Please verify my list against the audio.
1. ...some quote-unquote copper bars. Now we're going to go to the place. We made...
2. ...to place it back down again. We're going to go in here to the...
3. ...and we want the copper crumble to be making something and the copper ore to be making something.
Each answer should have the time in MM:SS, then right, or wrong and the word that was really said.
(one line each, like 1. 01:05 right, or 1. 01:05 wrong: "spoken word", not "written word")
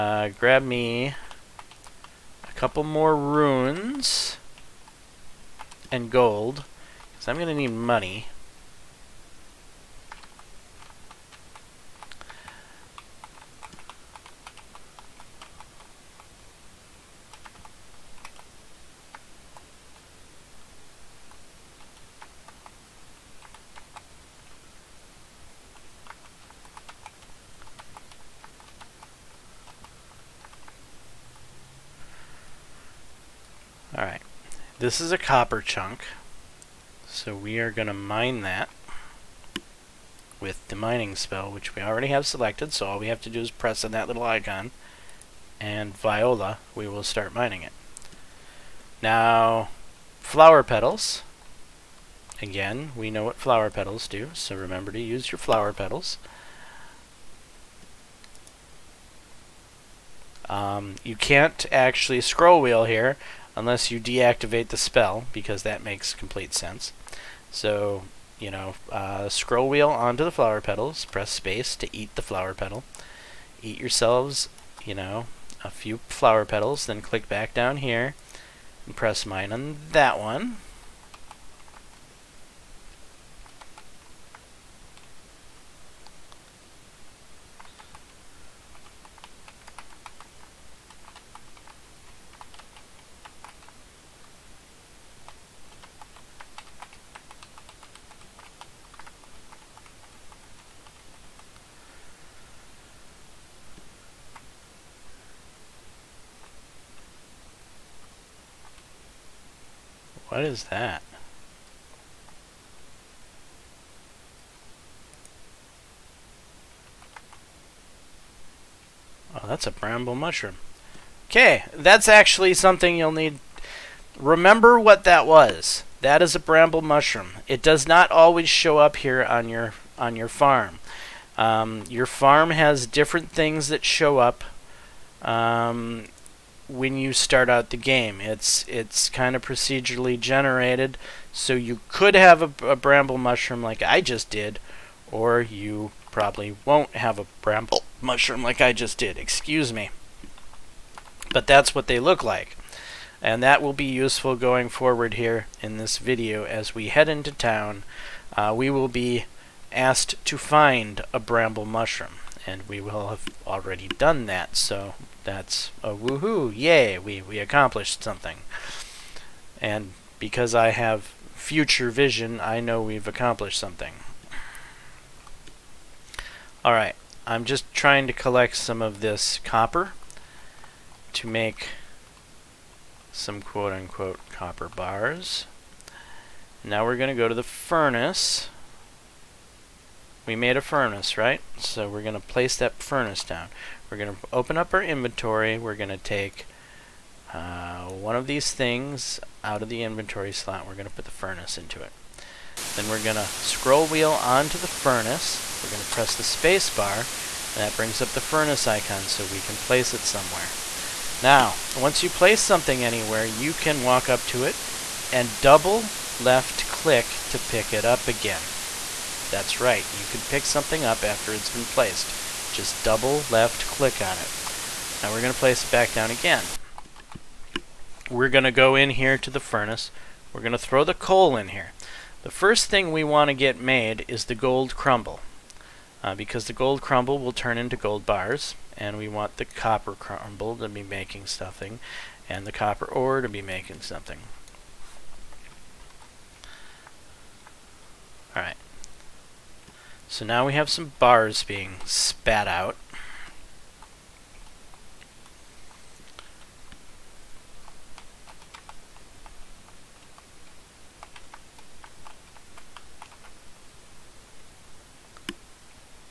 1. 03:03 wrong: "furnace", not "place"
2. 03:45 right
3. 03:58 right.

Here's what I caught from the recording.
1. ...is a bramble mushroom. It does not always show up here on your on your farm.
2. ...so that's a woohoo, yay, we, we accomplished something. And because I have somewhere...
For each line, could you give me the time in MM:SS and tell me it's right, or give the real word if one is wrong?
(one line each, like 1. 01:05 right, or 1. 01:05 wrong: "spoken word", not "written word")
1. 02:06 right
2. 02:44 wrong: "future", not "somewhere".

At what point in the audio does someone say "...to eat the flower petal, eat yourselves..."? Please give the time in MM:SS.
01:11.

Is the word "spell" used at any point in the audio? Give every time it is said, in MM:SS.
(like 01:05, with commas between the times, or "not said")
00:41, 01:04.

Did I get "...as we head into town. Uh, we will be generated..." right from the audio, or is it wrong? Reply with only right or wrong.
wrong.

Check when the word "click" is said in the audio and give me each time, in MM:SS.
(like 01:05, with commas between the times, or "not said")
01:17, 03:36, 03:43.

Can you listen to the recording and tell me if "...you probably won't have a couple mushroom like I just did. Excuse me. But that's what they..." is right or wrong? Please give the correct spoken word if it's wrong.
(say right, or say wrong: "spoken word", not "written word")
wrong: "bramble", not "couple".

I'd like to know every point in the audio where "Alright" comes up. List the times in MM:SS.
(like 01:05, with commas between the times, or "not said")
02:56, 04:08.